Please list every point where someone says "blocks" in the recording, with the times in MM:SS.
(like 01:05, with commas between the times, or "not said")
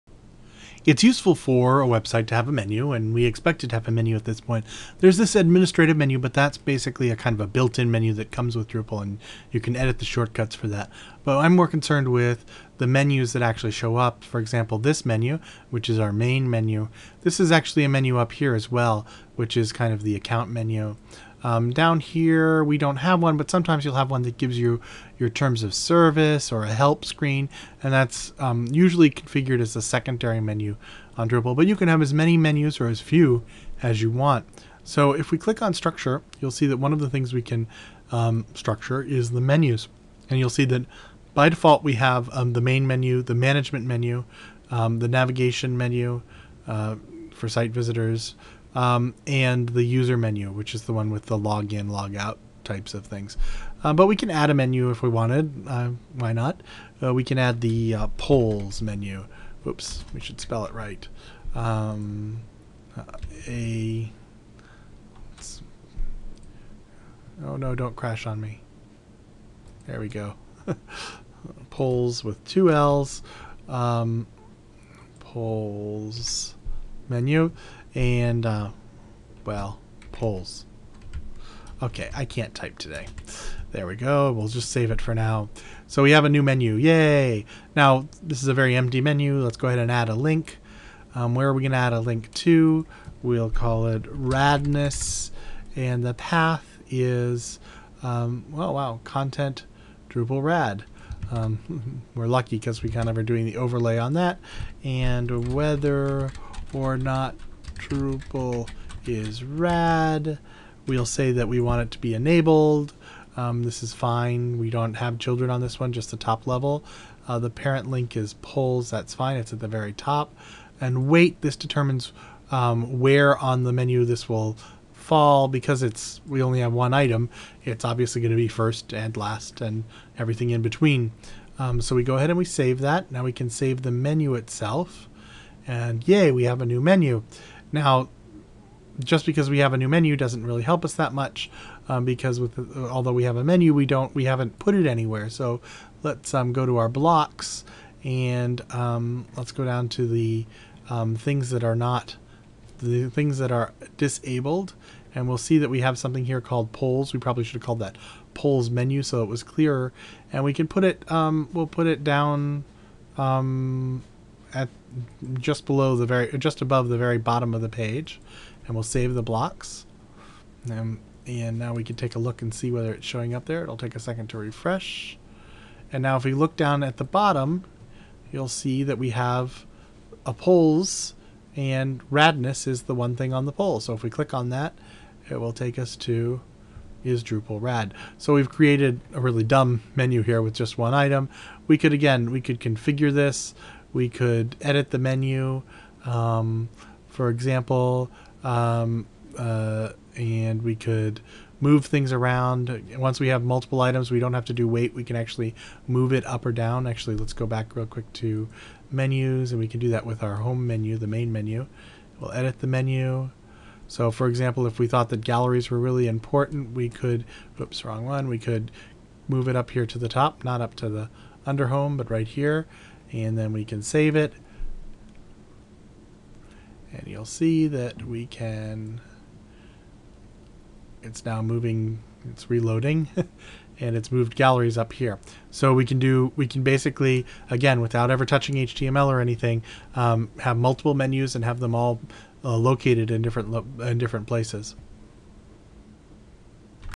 02:26, 02:49.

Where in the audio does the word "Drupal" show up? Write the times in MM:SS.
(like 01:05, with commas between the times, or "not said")
00:08, 00:31, 01:40, 01:47, 03:07.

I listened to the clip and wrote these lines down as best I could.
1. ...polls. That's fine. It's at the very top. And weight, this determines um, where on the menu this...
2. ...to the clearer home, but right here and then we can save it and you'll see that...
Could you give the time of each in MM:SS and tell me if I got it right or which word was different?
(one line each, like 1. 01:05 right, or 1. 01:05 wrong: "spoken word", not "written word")
1. 01:58 right
2. 03:40 wrong: "under", not "clearer".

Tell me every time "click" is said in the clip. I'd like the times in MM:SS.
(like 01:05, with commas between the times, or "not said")
00:35, 03:04.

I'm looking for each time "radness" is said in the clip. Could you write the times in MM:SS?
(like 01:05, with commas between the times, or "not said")
01:34, 03:02.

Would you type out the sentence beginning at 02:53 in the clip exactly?
It'll take a second to refresh.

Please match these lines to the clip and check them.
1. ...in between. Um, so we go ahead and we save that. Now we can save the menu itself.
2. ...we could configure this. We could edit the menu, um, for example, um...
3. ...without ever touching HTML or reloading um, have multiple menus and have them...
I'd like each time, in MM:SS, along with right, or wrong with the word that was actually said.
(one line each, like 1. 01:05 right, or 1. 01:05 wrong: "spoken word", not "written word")
1. 02:10 right
2. 03:12 right
3. 03:57 wrong: "anything", not "reloading".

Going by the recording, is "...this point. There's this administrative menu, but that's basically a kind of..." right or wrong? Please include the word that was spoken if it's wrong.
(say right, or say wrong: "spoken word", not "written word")
right.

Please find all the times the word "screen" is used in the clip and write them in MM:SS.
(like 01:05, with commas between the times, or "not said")
00:27.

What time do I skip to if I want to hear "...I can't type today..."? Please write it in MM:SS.
01:22.